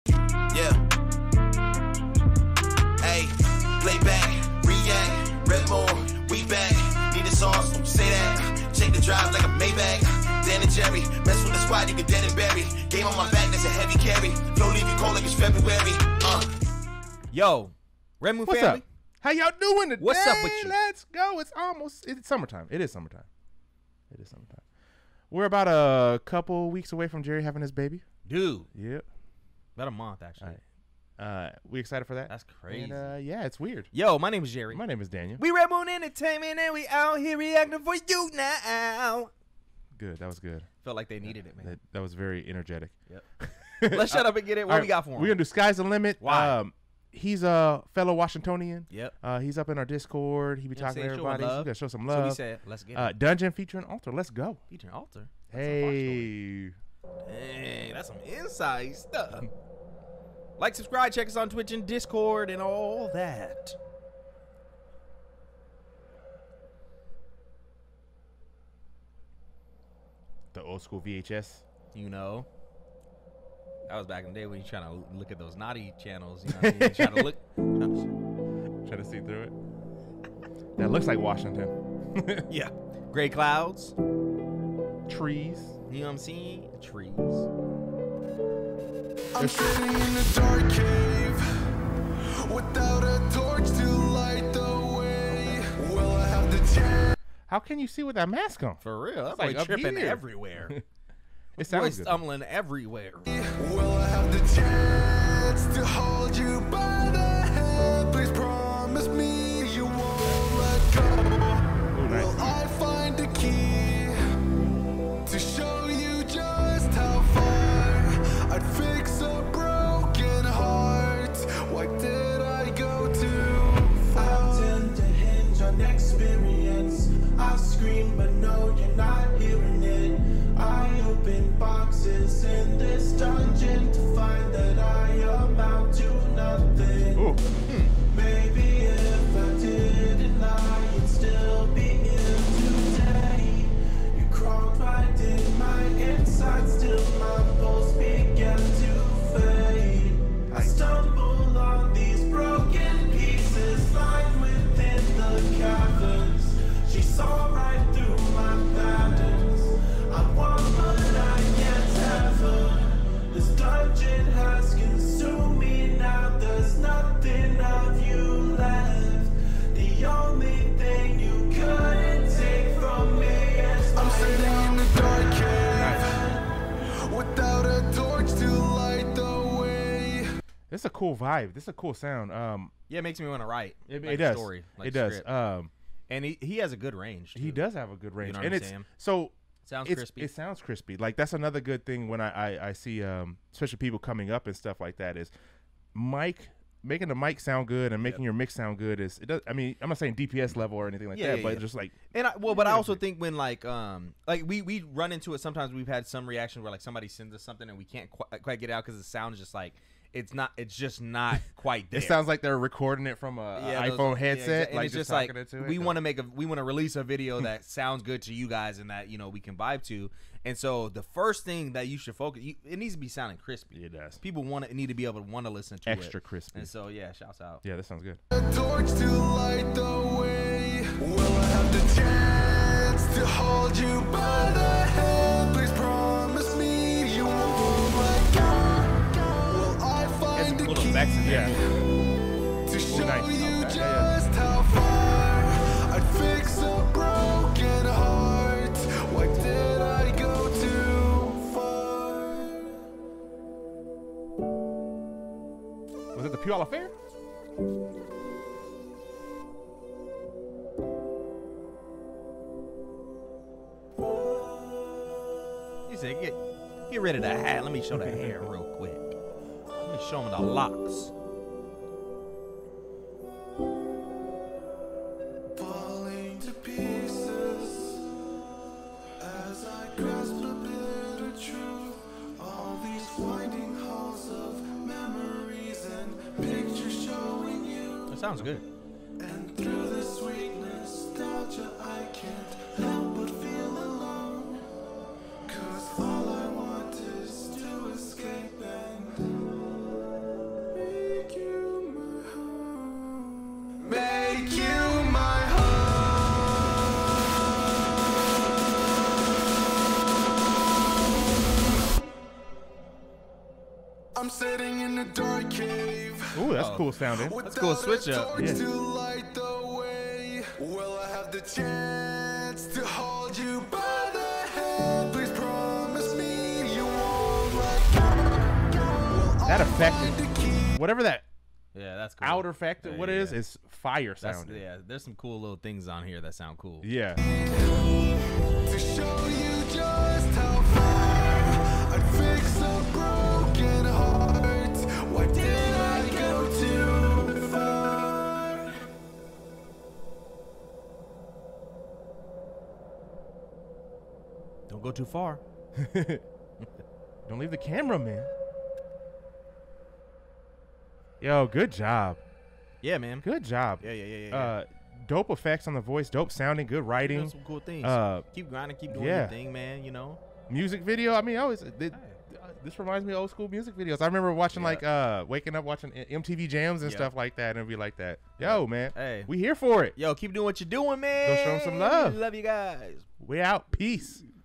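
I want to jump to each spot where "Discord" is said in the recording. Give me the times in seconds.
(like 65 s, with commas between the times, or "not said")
49 s, 61 s.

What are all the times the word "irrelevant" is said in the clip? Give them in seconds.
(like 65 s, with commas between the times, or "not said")
not said.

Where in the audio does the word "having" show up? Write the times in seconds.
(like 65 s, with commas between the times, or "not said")
27 s.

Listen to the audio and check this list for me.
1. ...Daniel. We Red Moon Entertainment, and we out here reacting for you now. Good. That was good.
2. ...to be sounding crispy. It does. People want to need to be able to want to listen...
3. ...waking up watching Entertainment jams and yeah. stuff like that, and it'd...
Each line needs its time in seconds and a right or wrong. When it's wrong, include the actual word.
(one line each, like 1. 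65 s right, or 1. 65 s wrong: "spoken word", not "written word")
1. 35 s right
2. 222 s right
3. 375 s wrong: "MTV", not "Entertainment".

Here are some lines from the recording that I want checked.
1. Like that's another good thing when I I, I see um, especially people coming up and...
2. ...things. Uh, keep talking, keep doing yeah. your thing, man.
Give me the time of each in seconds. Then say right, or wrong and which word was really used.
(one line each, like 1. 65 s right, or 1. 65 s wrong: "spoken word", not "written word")
1. 190 s right
2. 367 s wrong: "grinding", not "talking".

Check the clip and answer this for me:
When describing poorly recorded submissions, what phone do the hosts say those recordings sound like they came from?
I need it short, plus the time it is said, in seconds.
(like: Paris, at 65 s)
iPhone, at 213 s.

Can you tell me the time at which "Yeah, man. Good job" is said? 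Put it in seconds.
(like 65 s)
362 s.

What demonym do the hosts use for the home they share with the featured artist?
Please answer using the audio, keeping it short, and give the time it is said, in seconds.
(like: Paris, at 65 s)
Washingtonian, at 48 s.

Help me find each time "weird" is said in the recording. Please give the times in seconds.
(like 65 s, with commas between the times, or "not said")
33 s.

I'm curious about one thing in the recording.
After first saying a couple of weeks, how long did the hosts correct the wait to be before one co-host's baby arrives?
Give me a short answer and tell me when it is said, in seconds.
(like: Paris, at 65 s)
About a month, at 29 s.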